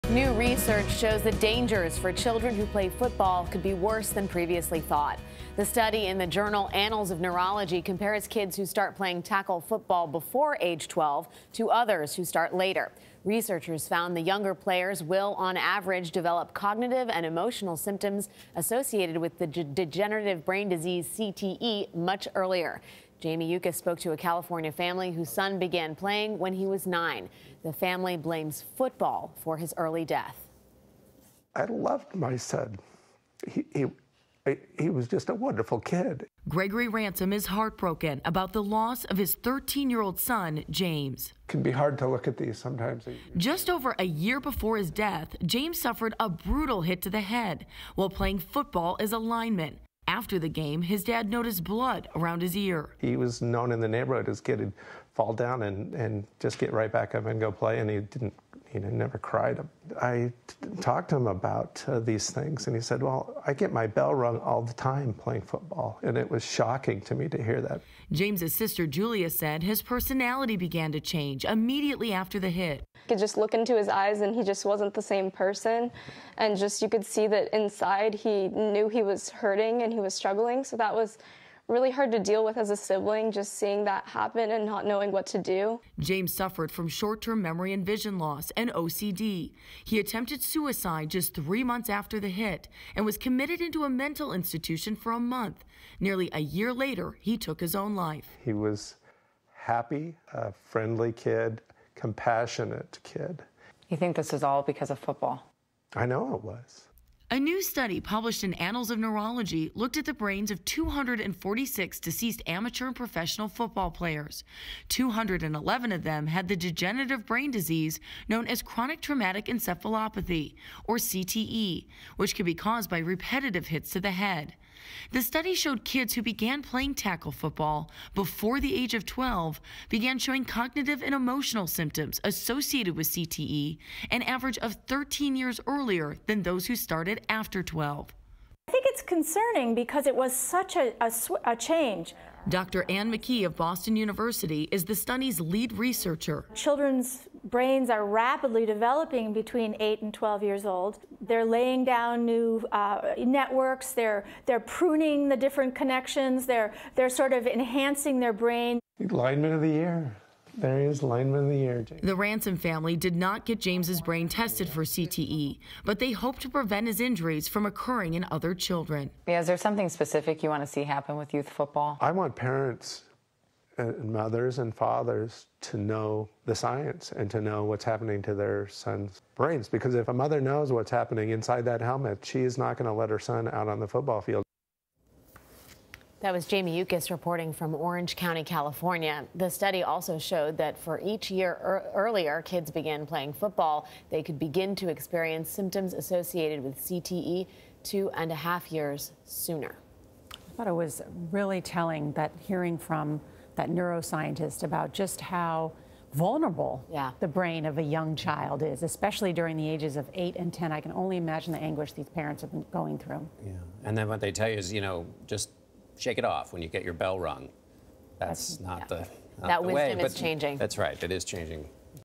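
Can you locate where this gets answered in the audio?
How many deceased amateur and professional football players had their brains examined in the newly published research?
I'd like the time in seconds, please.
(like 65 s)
110 s.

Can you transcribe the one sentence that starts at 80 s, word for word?
So that was really hard to deal with as a sibling, just seeing that happen and not knowing what to do.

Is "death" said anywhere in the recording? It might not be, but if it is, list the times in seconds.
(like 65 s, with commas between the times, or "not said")
30 s, 44 s.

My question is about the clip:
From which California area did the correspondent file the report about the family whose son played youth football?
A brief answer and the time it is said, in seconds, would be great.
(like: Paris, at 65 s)
Orange County, at 187 s.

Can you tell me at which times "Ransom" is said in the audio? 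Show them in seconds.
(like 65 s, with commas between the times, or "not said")
36 s, 162 s.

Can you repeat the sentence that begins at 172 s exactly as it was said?
I want parents and mothers and fathers to know the science and to know what's happening to their son's brains.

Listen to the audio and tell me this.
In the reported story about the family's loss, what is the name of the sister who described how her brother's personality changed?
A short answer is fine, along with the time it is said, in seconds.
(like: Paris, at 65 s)
Julia, at 68 s.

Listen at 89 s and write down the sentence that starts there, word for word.
He attempted suicide just three months after the hit and was committed into a mental institution for a month.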